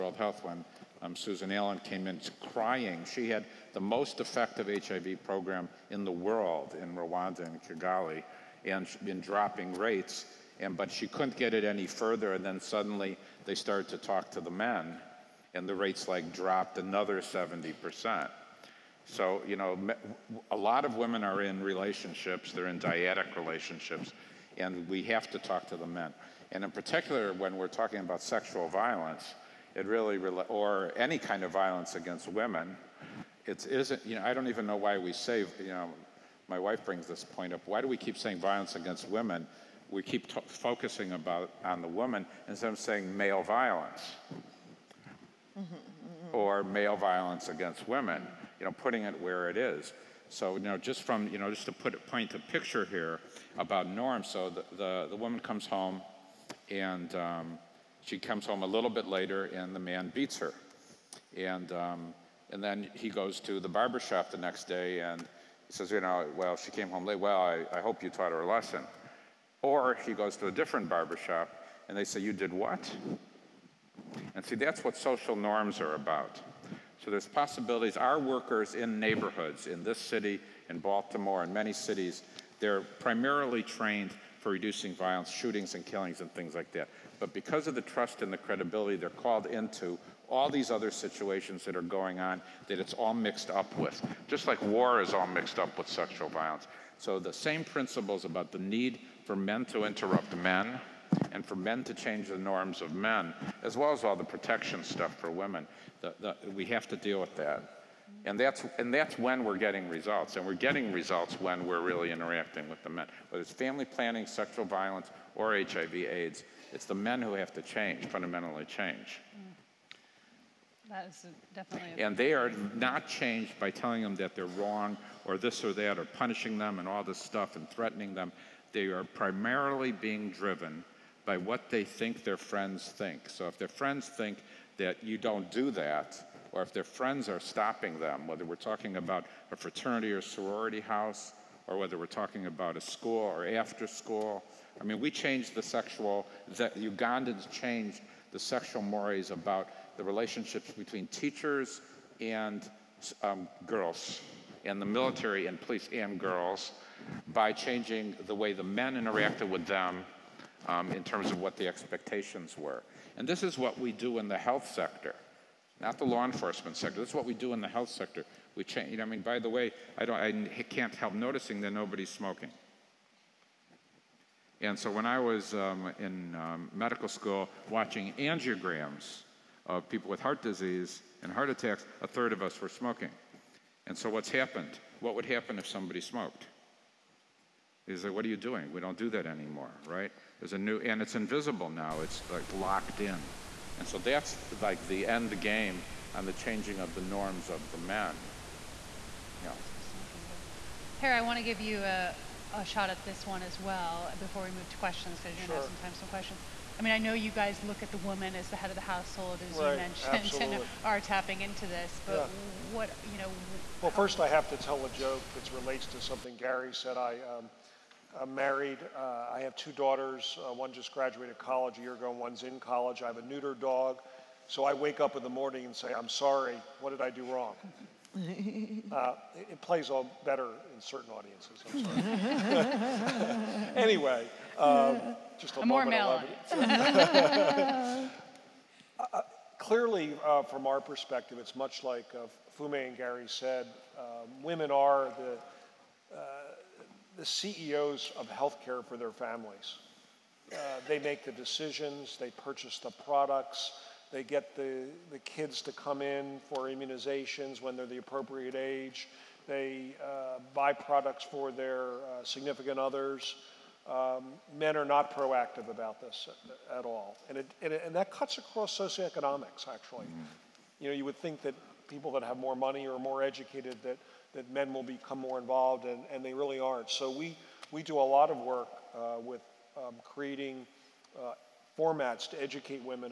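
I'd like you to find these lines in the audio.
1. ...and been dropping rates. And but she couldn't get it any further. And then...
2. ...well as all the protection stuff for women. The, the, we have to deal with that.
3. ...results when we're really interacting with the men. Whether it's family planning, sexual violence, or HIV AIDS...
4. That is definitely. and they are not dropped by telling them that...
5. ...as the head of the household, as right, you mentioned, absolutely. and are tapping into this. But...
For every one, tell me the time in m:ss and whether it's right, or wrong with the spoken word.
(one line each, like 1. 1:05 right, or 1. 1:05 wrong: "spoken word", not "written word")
1. 0:08 right
2. 1:43 right
3. 1:50 right
4. 2:00 wrong: "changed", not "dropped"
5. 3:28 right.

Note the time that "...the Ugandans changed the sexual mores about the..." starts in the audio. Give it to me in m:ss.
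2:26.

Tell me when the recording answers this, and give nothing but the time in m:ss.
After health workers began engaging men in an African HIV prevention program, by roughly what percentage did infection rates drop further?
0:17.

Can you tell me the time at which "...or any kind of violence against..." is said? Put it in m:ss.
0:30.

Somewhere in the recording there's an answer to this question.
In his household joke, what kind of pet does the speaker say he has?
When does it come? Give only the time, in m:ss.
3:43.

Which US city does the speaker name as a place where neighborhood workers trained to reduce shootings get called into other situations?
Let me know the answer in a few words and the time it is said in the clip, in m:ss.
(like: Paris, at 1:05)
Baltimore, at 1:20.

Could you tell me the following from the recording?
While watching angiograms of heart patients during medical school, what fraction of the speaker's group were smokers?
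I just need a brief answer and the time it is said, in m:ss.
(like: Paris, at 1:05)
A third, at 3:02.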